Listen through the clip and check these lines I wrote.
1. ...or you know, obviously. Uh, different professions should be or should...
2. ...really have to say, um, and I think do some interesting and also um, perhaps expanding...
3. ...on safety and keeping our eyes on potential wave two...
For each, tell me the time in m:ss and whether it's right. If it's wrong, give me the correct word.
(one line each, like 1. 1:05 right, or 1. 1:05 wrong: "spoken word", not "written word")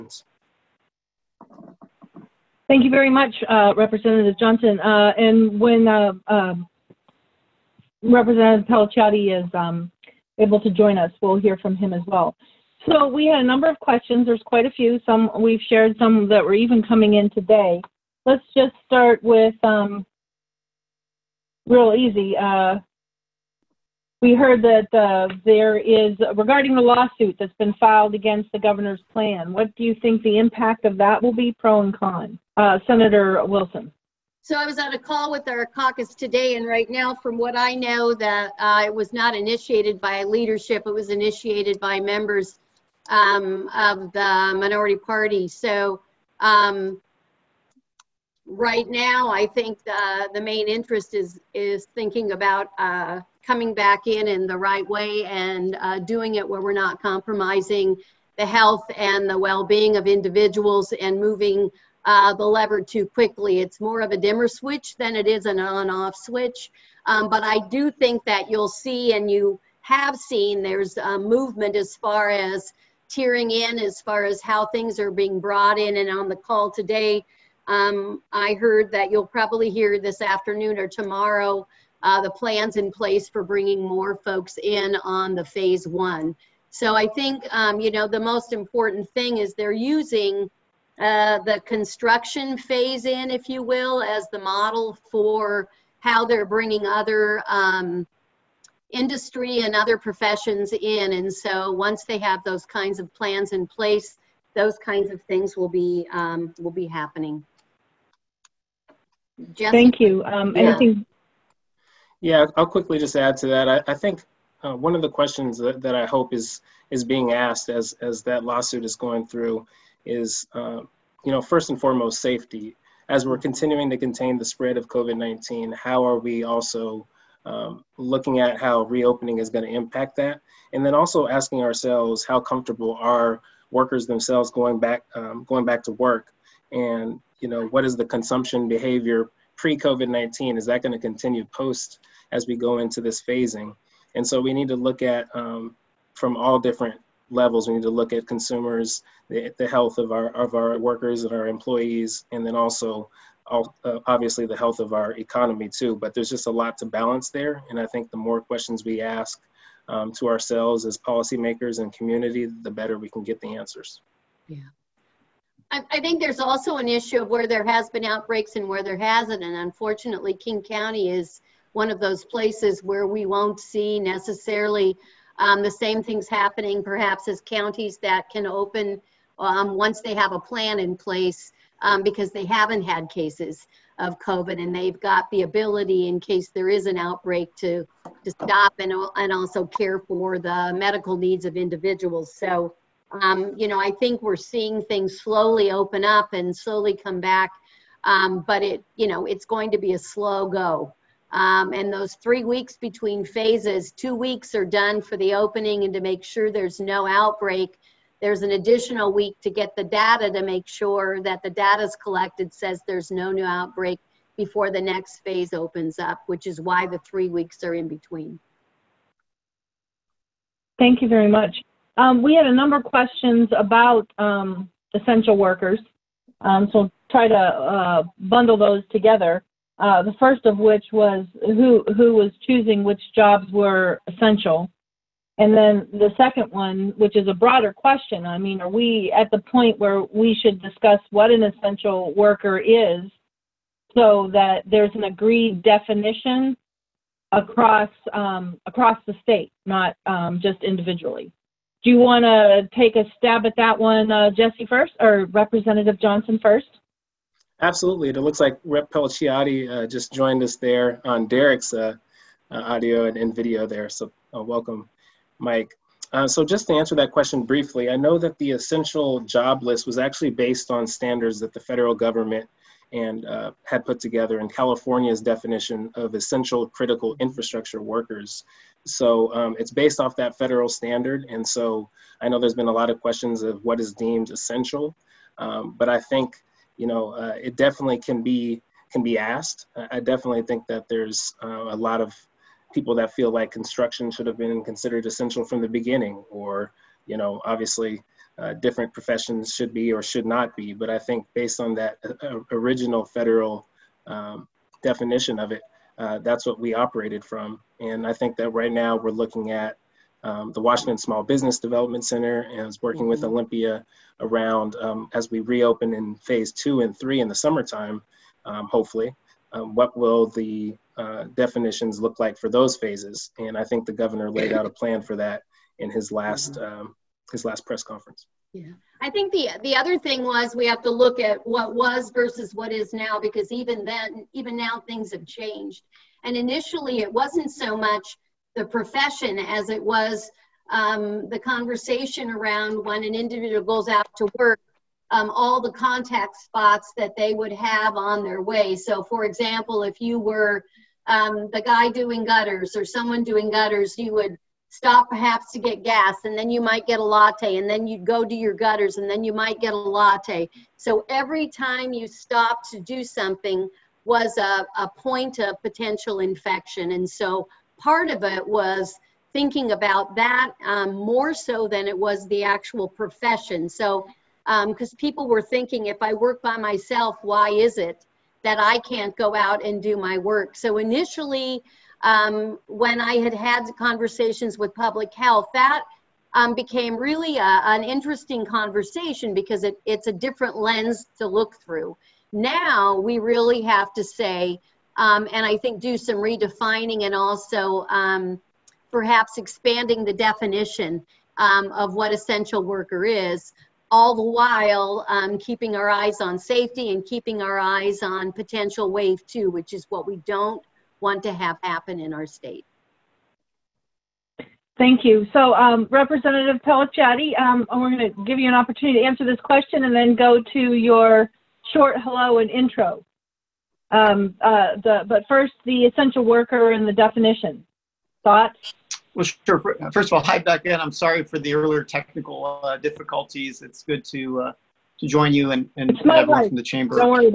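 1. 4:56 right
2. 6:33 wrong: "redefining", not "interesting"
3. 6:46 right.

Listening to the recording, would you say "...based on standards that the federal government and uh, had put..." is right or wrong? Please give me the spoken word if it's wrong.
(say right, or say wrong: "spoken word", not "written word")
right.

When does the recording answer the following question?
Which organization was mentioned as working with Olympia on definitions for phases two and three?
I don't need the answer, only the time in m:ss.
5:10.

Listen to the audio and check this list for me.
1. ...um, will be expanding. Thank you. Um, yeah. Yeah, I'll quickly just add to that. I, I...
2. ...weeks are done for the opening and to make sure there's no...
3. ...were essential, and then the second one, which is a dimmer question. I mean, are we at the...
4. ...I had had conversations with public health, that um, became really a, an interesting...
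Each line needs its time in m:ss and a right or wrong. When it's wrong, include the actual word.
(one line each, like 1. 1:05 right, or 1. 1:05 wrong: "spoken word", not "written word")
1. 1:46 wrong: "happening", not "expanding"
2. 3:24 right
3. 3:53 wrong: "broader", not "dimmer"
4. 6:22 right.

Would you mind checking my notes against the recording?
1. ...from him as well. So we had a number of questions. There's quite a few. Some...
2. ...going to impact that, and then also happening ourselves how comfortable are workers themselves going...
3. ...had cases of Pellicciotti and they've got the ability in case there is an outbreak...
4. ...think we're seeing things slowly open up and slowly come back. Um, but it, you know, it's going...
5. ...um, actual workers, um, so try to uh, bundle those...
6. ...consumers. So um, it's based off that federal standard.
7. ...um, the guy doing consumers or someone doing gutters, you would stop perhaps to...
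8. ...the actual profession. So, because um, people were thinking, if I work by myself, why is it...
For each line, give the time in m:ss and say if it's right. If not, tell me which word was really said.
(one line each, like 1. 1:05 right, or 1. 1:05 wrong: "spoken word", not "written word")
1. 0:11 right
2. 2:09 wrong: "asking", not "happening"
3. 3:02 wrong: "COVID", not "Pellicciotti"
4. 3:13 right
5. 3:44 wrong: "essential", not "actual"
6. 4:37 wrong: "workers", not "consumers"
7. 5:51 wrong: "gutters", not "consumers"
8. 6:12 right.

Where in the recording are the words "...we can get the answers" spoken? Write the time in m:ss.
2:42.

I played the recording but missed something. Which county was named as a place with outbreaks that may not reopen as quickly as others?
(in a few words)
King County.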